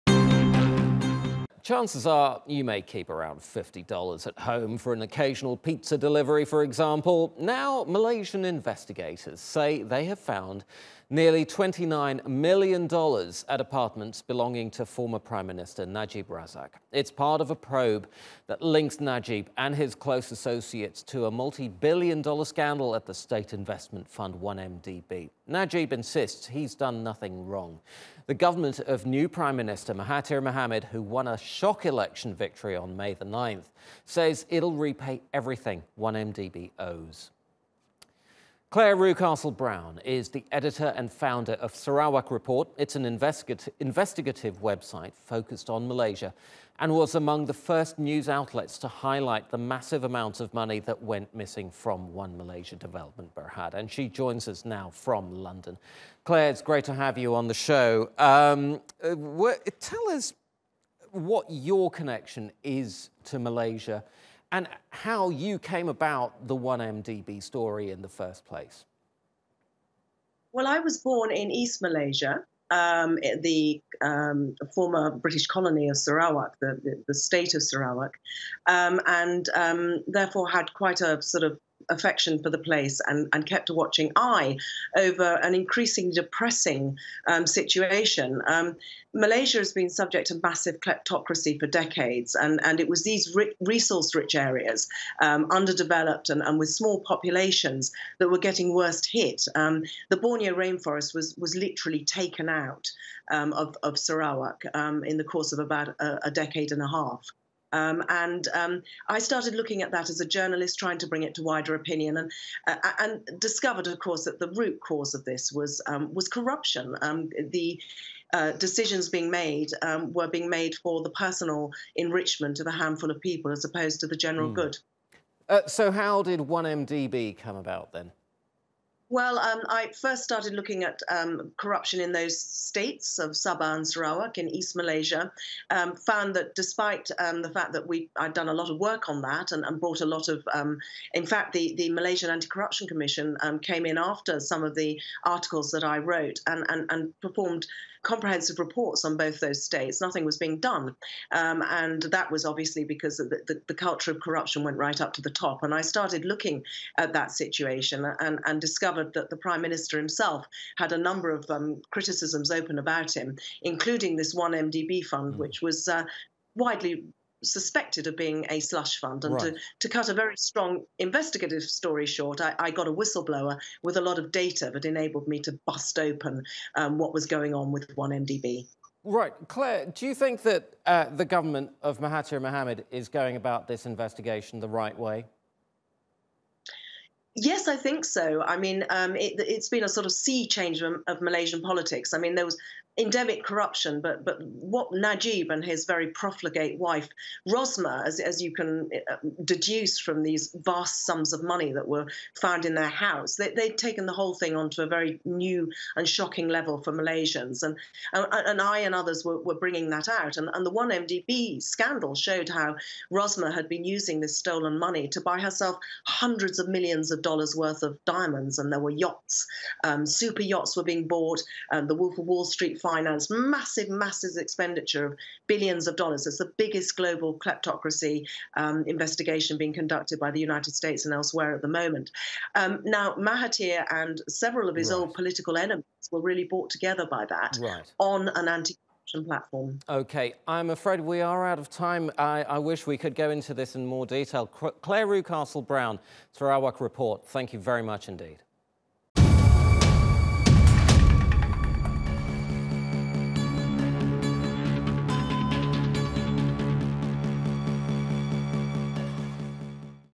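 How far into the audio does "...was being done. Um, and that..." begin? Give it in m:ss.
2:30.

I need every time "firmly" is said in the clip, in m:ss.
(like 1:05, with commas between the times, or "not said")
not said.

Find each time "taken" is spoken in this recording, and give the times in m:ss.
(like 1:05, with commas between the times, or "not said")
1:42, 3:23.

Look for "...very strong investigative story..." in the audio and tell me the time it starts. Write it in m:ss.
2:50.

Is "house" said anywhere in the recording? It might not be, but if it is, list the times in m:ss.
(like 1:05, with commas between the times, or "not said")
3:22.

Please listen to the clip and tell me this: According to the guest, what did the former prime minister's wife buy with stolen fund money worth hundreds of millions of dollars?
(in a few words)
diamonds.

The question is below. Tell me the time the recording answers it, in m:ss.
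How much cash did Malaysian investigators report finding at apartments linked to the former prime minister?
0:11.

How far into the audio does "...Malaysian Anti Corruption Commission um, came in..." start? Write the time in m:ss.
2:21.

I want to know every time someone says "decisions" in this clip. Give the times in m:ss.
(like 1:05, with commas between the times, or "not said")
1:58.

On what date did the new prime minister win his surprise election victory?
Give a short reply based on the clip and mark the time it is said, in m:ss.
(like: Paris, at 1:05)
May 9th, at 0:32.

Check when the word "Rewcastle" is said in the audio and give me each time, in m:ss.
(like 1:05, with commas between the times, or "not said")
0:38, 4:05.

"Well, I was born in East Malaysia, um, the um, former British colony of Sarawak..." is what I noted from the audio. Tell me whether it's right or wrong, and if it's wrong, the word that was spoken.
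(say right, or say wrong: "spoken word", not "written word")
right.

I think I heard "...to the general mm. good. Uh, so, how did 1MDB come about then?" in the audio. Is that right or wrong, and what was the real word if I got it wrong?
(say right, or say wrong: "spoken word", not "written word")
right.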